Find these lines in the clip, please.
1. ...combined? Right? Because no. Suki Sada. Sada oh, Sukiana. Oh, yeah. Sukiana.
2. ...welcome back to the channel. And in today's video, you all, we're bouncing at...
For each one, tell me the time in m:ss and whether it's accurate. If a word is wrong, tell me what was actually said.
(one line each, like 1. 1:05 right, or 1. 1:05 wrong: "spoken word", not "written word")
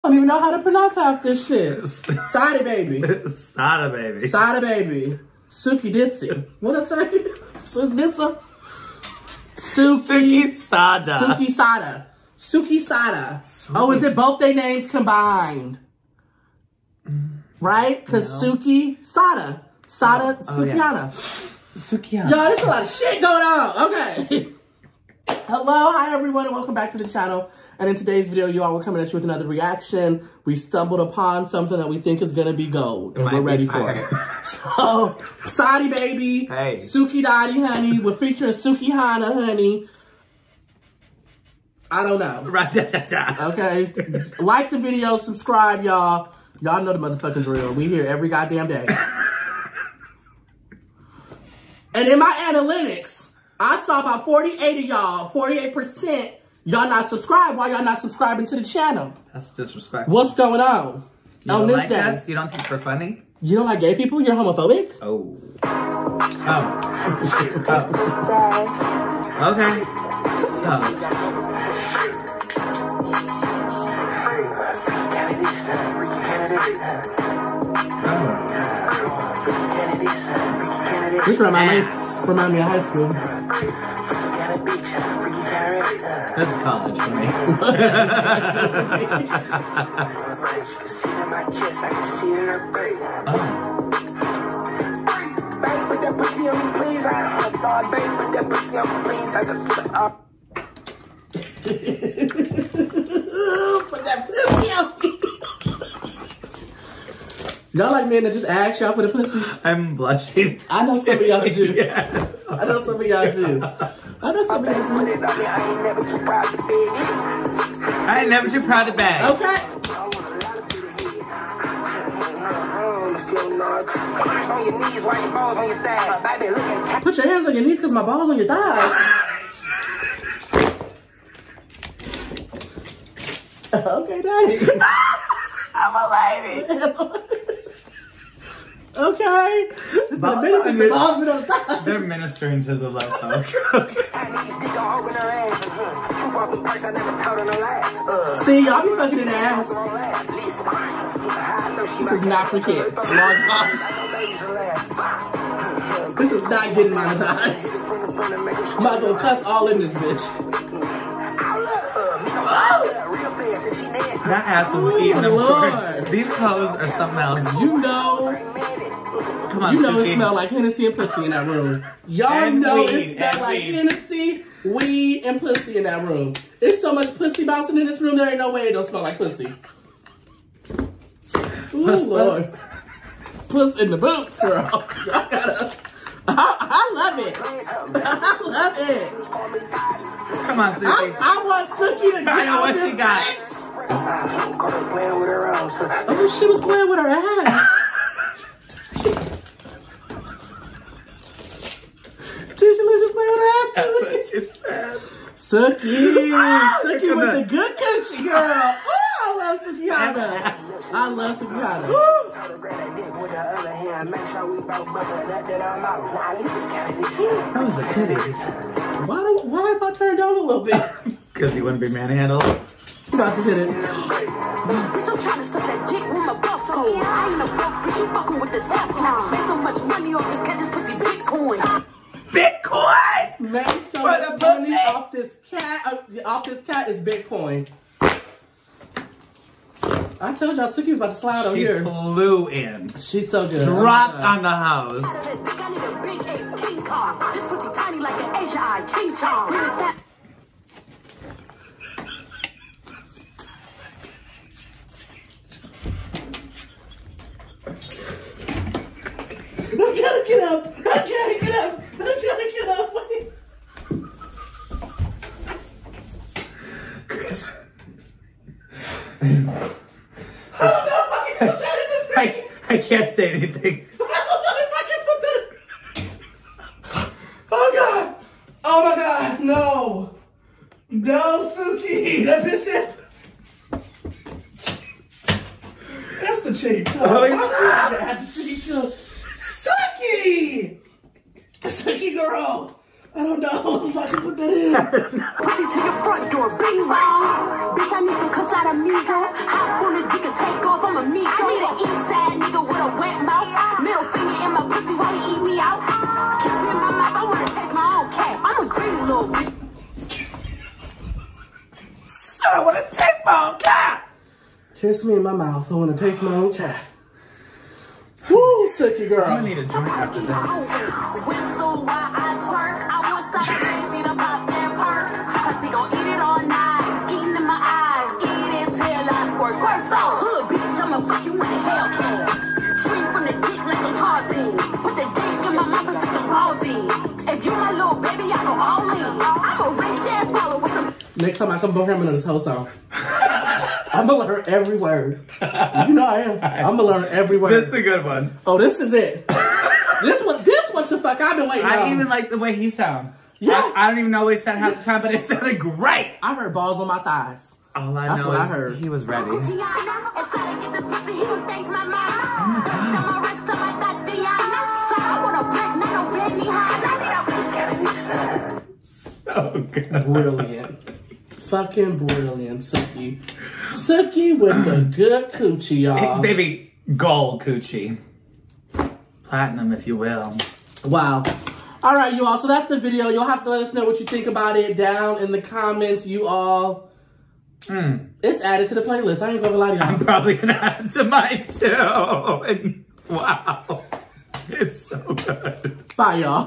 1. 0:14 right
2. 0:26 wrong: "coming", not "bouncing".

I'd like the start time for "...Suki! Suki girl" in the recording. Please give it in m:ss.
4:49.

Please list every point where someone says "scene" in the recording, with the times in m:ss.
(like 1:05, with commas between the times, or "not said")
not said.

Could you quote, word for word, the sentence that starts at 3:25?
Ah, Suki, Suki with the good country girl.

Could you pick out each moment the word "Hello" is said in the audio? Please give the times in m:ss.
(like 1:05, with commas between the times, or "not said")
0:25.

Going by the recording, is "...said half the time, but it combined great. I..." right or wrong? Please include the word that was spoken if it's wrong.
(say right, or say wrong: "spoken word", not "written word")
wrong: "sounded", not "combined".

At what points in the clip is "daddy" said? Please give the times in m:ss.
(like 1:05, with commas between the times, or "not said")
0:37, 2:14.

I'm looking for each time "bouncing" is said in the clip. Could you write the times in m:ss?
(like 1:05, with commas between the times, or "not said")
2:57.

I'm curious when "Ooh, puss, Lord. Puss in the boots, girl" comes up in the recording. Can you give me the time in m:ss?
3:01.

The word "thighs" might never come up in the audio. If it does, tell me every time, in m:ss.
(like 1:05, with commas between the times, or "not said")
2:08, 5:56.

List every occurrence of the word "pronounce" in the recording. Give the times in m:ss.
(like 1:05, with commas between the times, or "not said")
0:00.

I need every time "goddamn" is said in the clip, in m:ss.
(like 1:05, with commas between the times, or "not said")
0:48.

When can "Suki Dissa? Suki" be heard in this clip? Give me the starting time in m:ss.
0:07.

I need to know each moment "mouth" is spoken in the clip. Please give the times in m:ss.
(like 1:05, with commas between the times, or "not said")
5:15.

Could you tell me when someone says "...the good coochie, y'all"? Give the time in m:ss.
6:14.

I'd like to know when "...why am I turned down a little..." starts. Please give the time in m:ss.
3:39.